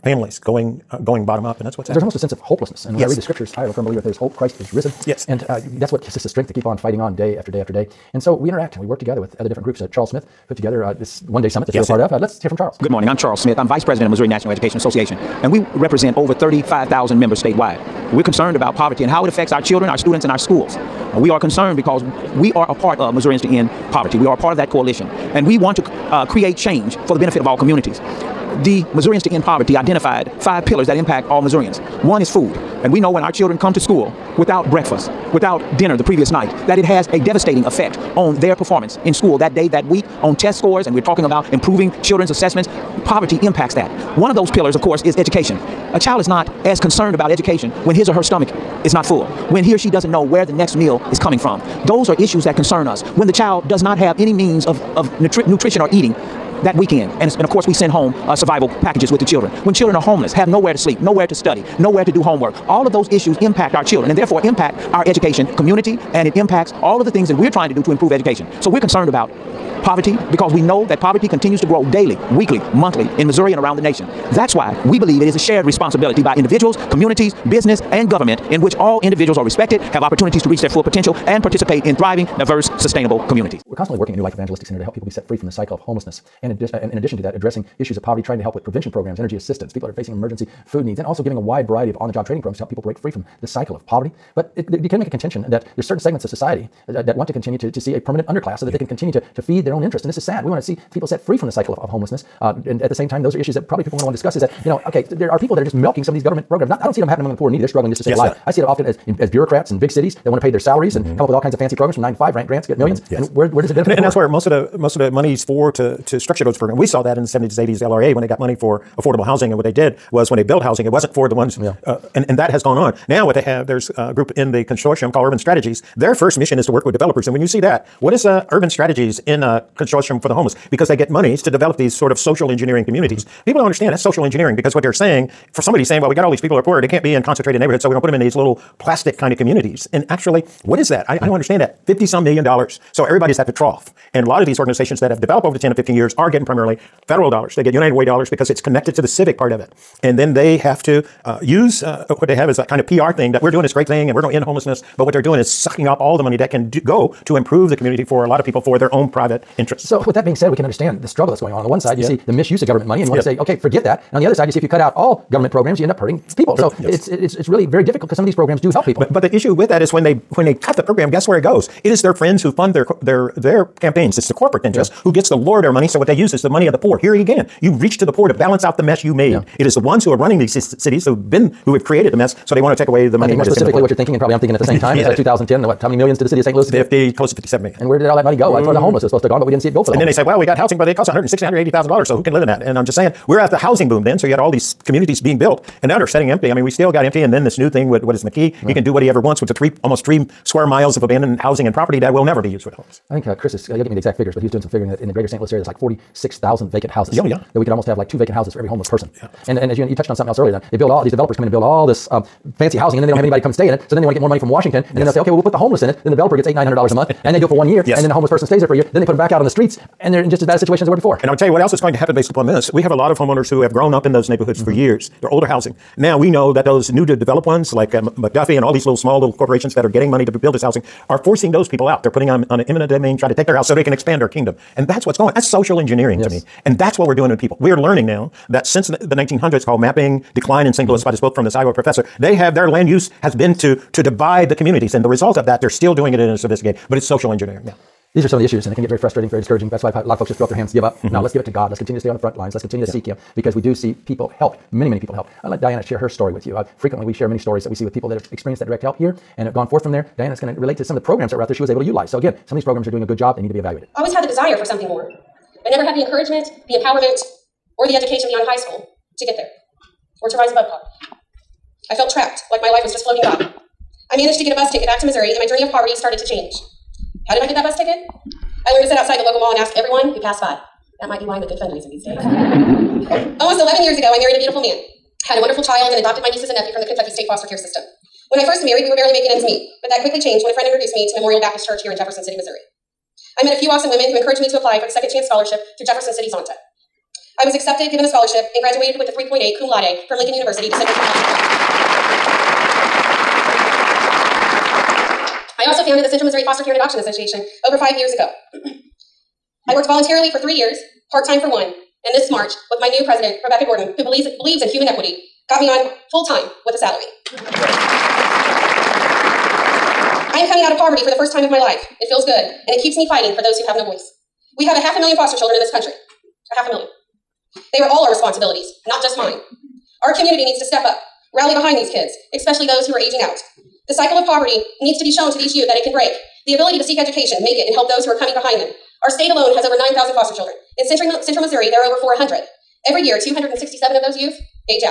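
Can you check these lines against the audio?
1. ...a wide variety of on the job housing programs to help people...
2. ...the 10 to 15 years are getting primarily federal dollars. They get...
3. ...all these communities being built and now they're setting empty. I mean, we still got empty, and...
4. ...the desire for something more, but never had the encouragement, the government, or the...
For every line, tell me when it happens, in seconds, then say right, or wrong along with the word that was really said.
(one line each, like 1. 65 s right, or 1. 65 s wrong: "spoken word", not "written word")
1. 91 s wrong: "training", not "housing"
2. 145 s right
3. 194 s right
4. 264 s wrong: "empowerment", not "government".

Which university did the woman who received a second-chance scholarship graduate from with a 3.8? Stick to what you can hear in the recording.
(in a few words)
Lincoln University.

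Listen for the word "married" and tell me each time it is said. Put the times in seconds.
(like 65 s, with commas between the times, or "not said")
284 s, 288 s.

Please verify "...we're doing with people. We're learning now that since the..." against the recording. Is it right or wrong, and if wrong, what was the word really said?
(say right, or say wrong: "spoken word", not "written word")
right.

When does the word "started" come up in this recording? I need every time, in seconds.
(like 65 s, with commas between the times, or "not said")
275 s.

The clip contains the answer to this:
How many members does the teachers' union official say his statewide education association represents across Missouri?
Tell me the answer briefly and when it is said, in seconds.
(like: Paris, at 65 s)
35,000, at 16 s.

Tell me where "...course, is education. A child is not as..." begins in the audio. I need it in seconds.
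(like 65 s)
44 s.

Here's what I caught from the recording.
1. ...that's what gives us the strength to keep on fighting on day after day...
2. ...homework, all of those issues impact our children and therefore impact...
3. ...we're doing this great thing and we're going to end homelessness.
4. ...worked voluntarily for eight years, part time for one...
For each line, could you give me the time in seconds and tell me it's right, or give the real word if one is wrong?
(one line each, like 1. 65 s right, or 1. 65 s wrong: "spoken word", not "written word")
1. 5 s right
2. 62 s right
3. 153 s right
4. 309 s wrong: "three", not "eight".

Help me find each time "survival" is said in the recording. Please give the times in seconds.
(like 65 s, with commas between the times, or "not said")
58 s.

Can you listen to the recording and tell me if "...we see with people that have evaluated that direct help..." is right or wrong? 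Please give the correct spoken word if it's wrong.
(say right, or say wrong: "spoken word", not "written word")
wrong: "experienced", not "evaluated".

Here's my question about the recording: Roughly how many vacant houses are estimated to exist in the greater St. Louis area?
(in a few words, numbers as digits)
46,000.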